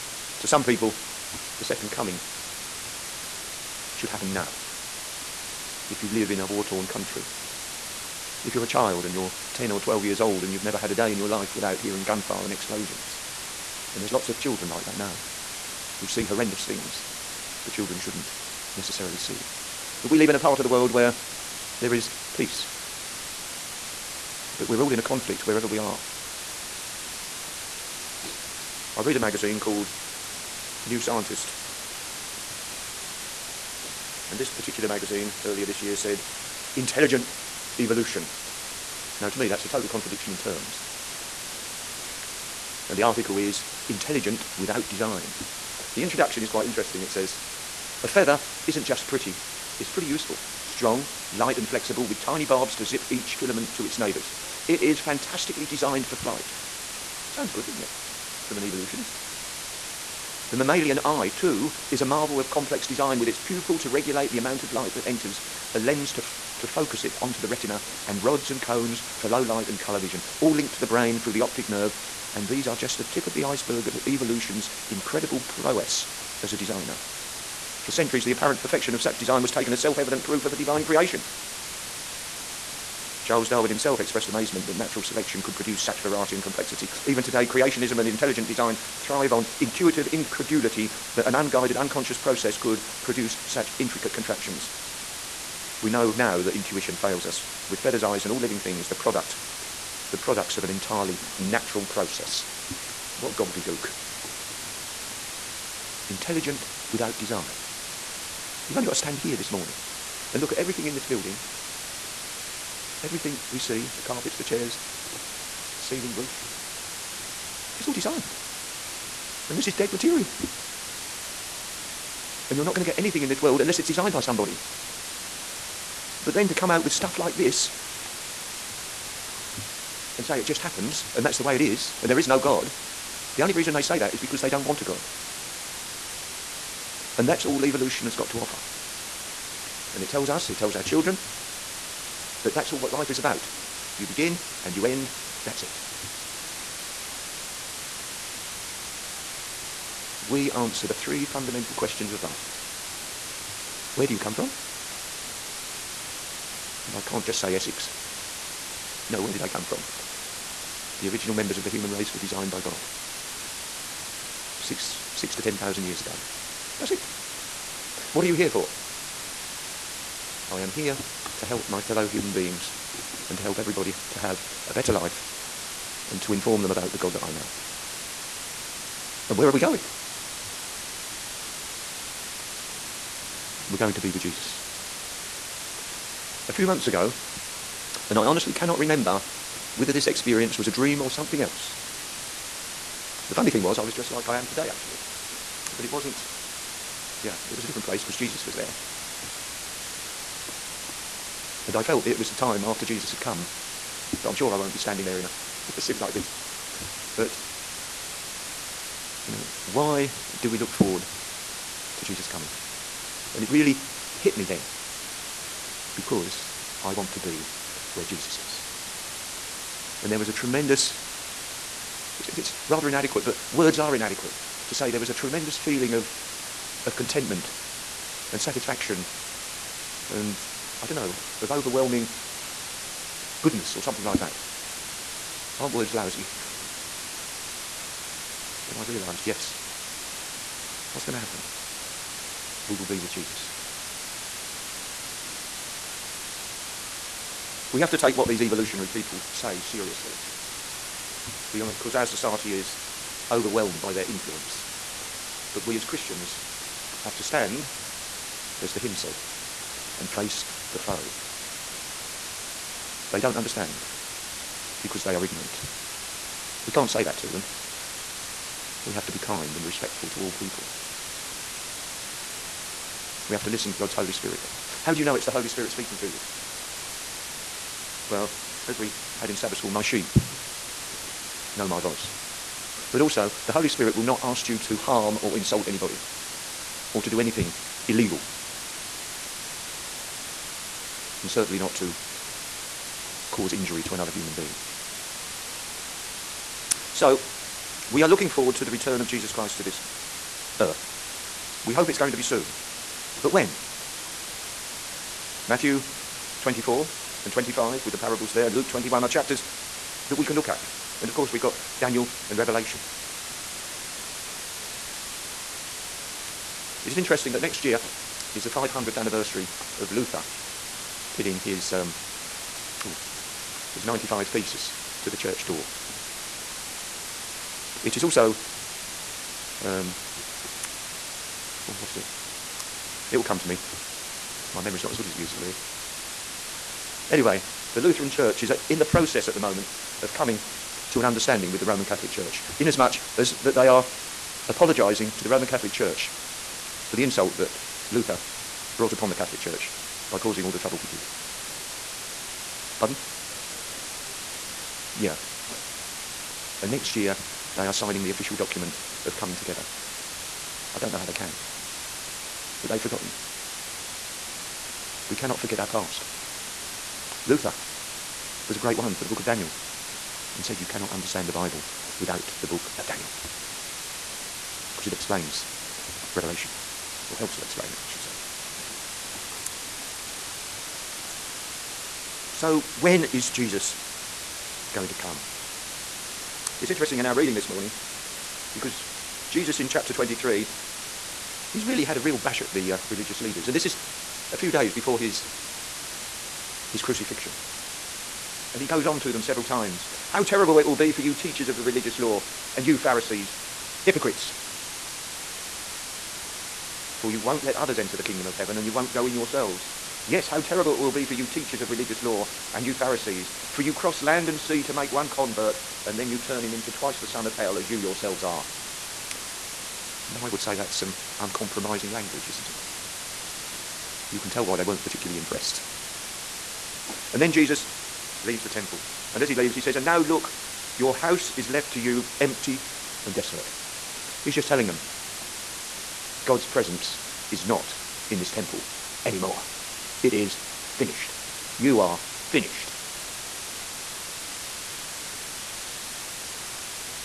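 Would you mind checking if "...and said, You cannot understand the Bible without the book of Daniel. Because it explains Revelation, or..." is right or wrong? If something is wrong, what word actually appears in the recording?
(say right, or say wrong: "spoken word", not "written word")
right.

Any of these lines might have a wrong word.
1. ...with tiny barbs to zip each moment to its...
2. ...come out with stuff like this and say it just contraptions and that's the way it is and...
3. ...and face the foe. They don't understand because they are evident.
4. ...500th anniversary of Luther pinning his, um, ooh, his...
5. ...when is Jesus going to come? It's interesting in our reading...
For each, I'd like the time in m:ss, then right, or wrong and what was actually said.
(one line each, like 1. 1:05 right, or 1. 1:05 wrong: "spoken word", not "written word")
1. 0:52 wrong: "filament", not "moment"
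2. 2:06 wrong: "happens", not "contraptions"
3. 4:19 wrong: "ignorant", not "evident"
4. 5:18 right
5. 6:22 right.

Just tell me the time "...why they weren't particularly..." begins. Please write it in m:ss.
7:04.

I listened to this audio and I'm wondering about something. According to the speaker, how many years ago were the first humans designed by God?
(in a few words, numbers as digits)
6 to 10 thousand.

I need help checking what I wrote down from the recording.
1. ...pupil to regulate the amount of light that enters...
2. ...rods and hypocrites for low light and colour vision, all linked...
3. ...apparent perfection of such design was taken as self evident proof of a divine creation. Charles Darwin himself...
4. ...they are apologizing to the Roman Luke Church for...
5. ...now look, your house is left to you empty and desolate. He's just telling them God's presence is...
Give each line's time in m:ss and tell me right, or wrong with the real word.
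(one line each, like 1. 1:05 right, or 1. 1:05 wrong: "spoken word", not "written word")
1. 1:03 right
2. 1:08 wrong: "cones", not "hypocrites"
3. 1:18 right
4. 5:43 wrong: "Catholic", not "Luke"
5. 7:09 right.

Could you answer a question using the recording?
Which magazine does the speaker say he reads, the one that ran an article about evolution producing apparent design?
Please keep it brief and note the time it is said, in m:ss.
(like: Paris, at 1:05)
New Scientist, at 0:30.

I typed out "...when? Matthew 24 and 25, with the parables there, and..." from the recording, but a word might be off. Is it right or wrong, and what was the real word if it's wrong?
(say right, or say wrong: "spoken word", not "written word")
right.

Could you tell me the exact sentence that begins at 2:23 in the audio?
You begin and you end, that's it.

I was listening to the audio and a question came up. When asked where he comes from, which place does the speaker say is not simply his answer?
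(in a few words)
Essex.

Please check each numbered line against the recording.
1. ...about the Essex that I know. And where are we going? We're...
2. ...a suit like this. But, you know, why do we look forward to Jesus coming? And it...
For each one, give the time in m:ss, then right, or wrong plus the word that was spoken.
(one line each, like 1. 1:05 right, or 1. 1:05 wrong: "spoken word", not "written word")
1. 2:56 wrong: "God", not "Essex"
2. 3:25 right.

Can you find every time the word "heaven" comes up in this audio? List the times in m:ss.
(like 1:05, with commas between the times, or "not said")
6:48.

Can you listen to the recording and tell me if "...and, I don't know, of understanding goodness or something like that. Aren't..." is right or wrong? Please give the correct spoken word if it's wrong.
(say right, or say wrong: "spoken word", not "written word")
wrong: "overwhelming", not "understanding".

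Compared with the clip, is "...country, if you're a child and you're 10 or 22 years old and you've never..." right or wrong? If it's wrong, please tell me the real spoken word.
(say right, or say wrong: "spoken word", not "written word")
wrong: "12", not "22".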